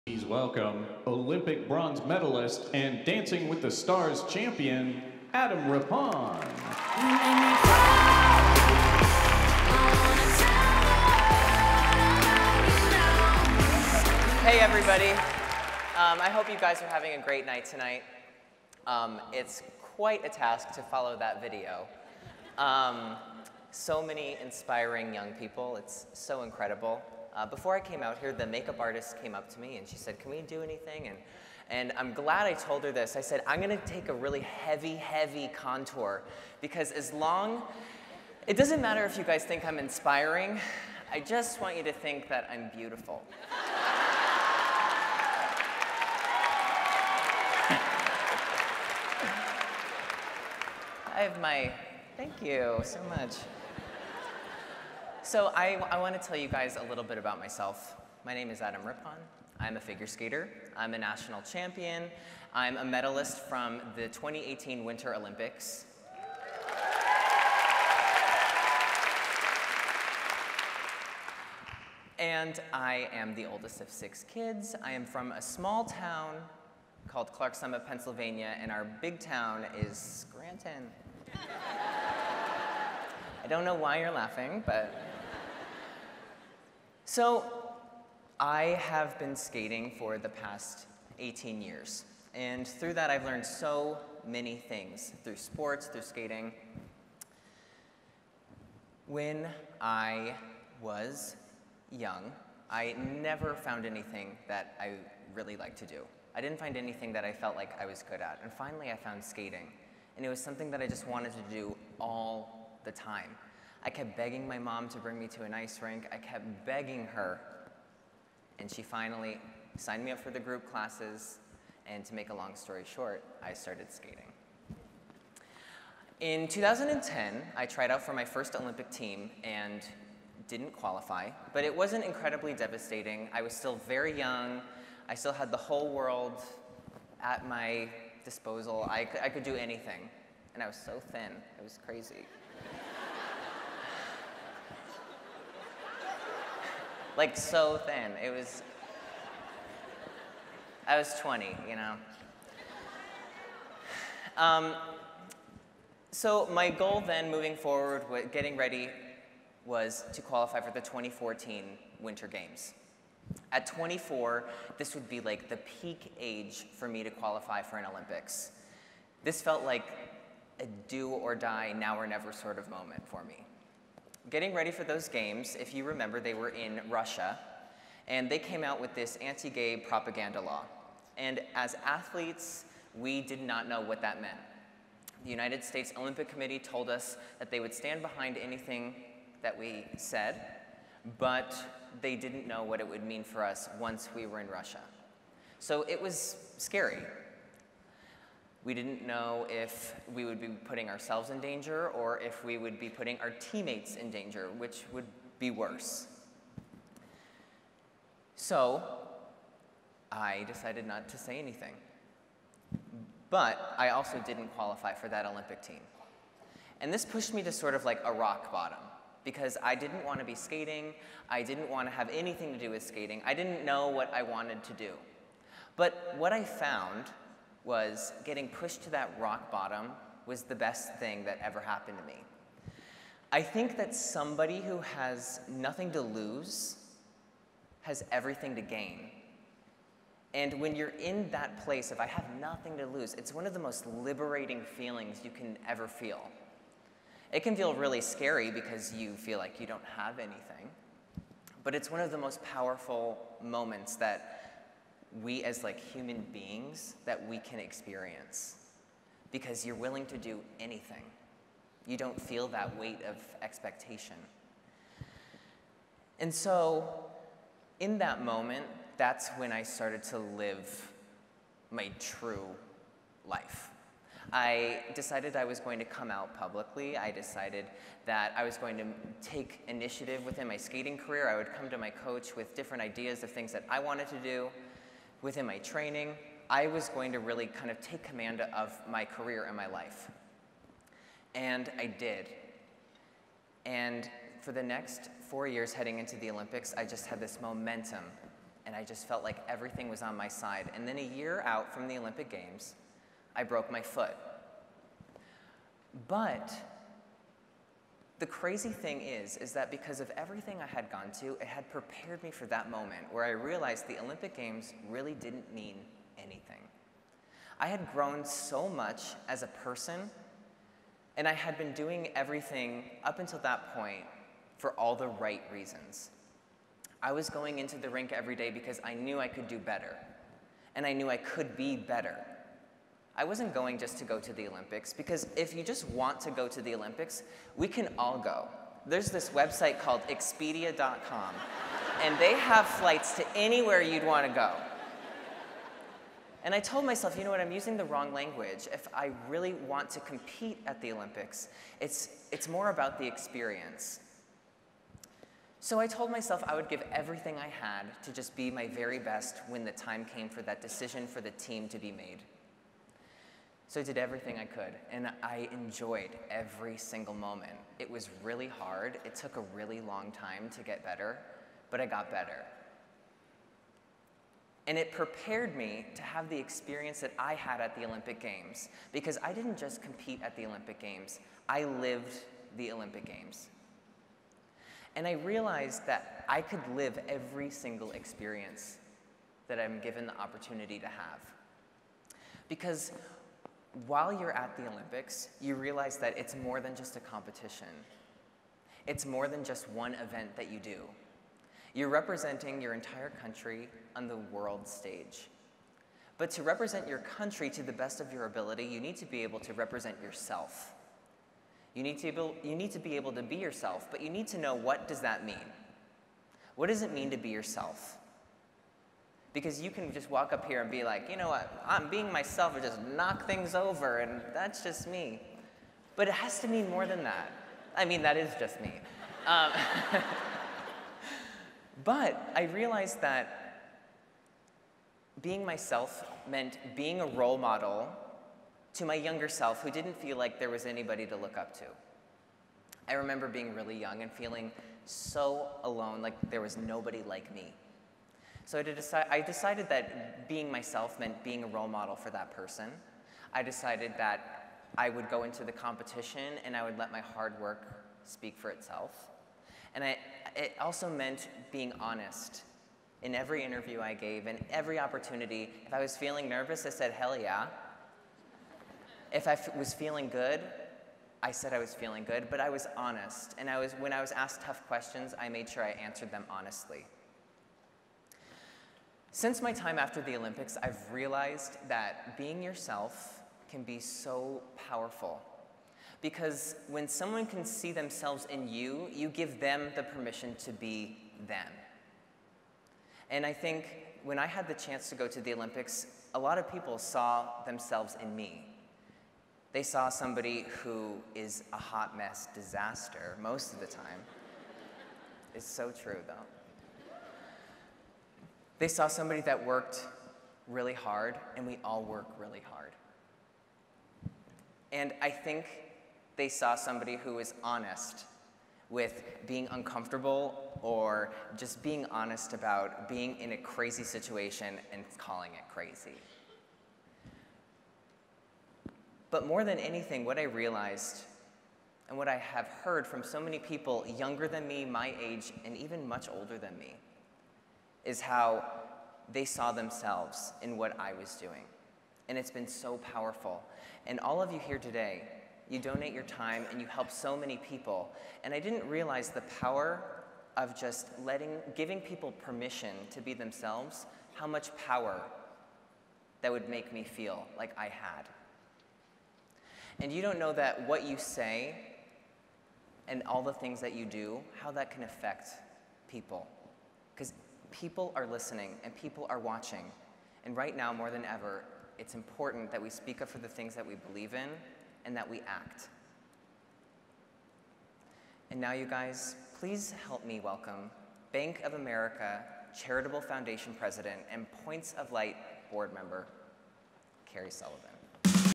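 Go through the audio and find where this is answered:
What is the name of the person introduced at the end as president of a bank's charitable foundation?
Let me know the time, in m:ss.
9:47.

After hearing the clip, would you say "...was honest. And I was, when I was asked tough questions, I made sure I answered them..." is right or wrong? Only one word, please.
right.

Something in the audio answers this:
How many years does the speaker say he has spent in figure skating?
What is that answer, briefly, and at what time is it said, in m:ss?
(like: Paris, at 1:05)
18 years, at 1:31.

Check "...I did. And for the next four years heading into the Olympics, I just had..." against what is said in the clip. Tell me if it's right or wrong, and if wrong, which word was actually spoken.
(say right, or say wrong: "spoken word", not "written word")
right.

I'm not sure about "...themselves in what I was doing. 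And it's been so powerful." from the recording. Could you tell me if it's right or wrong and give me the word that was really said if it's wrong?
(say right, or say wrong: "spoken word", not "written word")
right.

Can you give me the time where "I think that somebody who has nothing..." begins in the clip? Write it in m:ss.
3:53.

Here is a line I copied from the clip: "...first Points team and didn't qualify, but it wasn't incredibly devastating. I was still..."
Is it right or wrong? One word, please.
wrong.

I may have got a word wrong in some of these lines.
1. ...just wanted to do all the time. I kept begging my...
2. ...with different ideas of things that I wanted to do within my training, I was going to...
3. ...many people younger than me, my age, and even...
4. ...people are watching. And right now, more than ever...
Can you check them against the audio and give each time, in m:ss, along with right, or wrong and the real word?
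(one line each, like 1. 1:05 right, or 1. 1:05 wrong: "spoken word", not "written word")
1. 1:50 right
2. 4:42 right
3. 8:53 right
4. 9:28 right.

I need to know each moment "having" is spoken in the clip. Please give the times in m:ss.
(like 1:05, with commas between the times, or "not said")
0:16.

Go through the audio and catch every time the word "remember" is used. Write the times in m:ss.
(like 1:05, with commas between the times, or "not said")
2:55, 7:22.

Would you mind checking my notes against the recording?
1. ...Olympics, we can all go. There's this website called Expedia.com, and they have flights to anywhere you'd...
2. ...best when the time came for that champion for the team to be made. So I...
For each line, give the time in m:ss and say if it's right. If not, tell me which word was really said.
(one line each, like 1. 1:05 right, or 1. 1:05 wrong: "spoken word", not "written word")
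1. 5:36 right
2. 5:58 wrong: "decision", not "champion".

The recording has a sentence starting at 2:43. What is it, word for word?
At 24, this would be like the peak age for me to qualify for an Olympics.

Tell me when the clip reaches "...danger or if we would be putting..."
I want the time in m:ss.
3:21.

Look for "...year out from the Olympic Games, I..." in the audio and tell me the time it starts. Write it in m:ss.
5:01.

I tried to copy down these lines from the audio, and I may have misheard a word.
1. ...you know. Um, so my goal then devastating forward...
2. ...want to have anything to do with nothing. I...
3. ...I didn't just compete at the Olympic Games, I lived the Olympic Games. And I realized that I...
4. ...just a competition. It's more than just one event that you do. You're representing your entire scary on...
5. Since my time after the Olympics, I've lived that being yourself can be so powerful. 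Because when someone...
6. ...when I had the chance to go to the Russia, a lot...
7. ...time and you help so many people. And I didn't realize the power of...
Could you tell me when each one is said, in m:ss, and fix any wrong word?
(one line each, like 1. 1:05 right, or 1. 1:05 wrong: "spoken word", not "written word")
1. 2:31 wrong: "moving", not "devastating"
2. 3:41 wrong: "skating", not "nothing"
3. 6:19 right
4. 6:36 wrong: "country", not "scary"
5. 7:59 wrong: "realized", not "lived"
6. 8:14 wrong: "Olympics", not "Russia"
7. 9:06 right.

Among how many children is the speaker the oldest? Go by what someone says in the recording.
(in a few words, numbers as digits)
6.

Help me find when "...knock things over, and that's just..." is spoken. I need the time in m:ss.
7:02.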